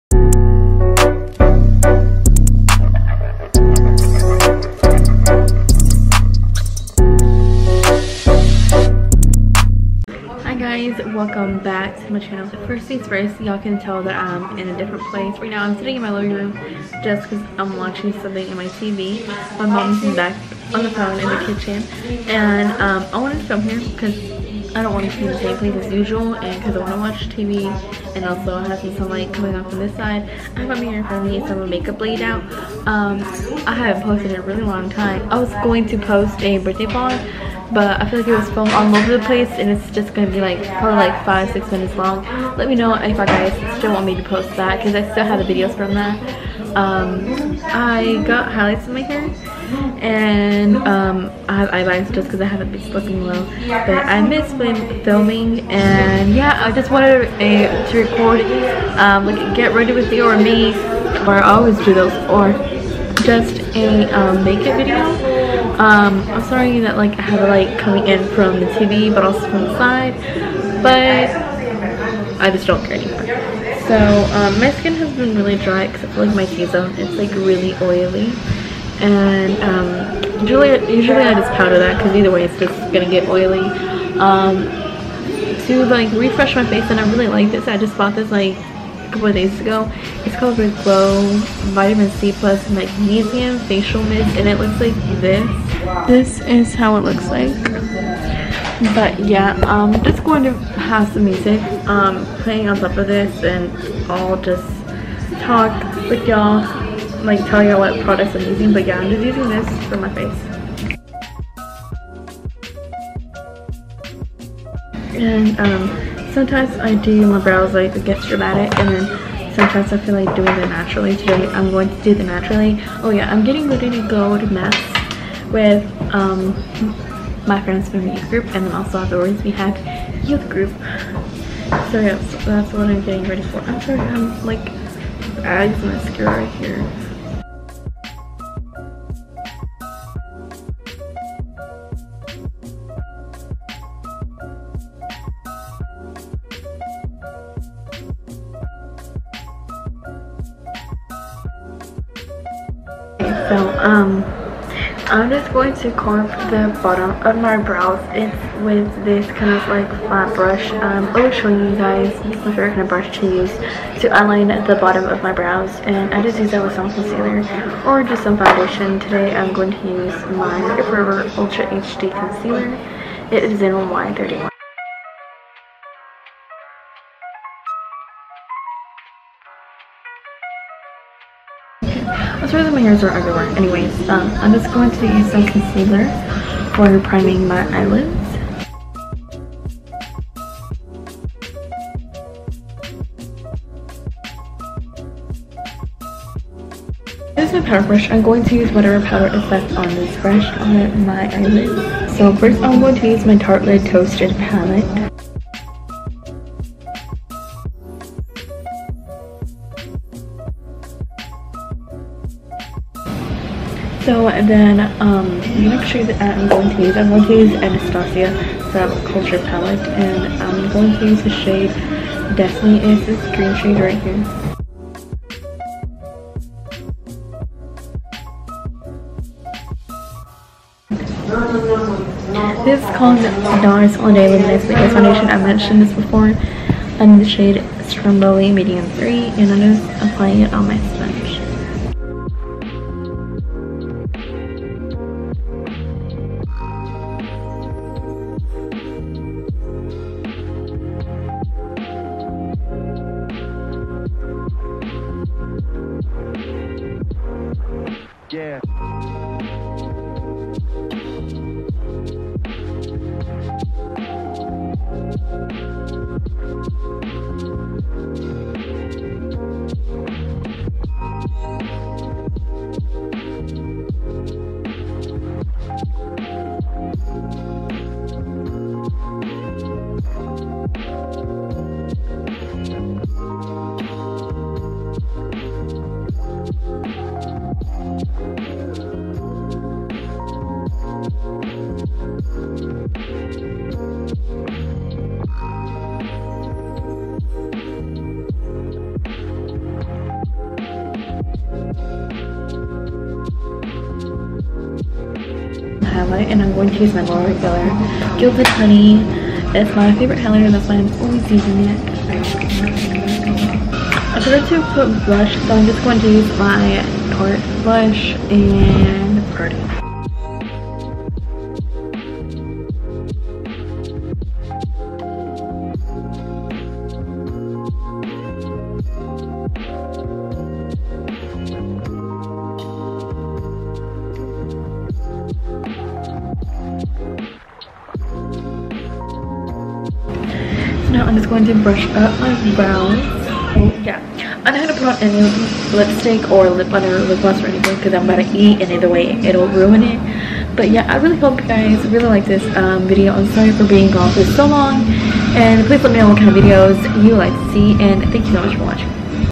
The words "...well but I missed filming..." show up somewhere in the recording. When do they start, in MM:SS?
00:53.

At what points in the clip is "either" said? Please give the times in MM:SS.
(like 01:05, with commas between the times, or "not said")
01:22, 05:48.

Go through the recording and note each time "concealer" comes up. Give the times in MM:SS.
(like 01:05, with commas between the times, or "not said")
02:46, 02:52, 03:05.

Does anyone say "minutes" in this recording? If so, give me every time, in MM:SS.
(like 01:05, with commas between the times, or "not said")
00:41.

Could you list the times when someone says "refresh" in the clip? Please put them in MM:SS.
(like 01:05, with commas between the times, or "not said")
01:26.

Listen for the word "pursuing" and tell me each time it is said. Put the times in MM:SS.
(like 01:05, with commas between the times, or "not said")
not said.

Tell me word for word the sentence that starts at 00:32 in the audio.
Um, I haven't posted in a really long time.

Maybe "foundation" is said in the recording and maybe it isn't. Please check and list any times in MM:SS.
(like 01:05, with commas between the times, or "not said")
02:48, 03:54.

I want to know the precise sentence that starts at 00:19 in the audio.
My mom's back on the phone in the kitchen.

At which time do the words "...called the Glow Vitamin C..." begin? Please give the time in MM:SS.
01:30.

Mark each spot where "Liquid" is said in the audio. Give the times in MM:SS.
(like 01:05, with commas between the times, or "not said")
03:54.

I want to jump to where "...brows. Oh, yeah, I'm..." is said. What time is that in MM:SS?
05:42.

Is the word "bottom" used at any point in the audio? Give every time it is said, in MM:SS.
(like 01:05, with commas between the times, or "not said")
02:36, 02:44.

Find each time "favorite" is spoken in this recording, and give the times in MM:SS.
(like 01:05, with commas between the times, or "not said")
02:42, 05:09.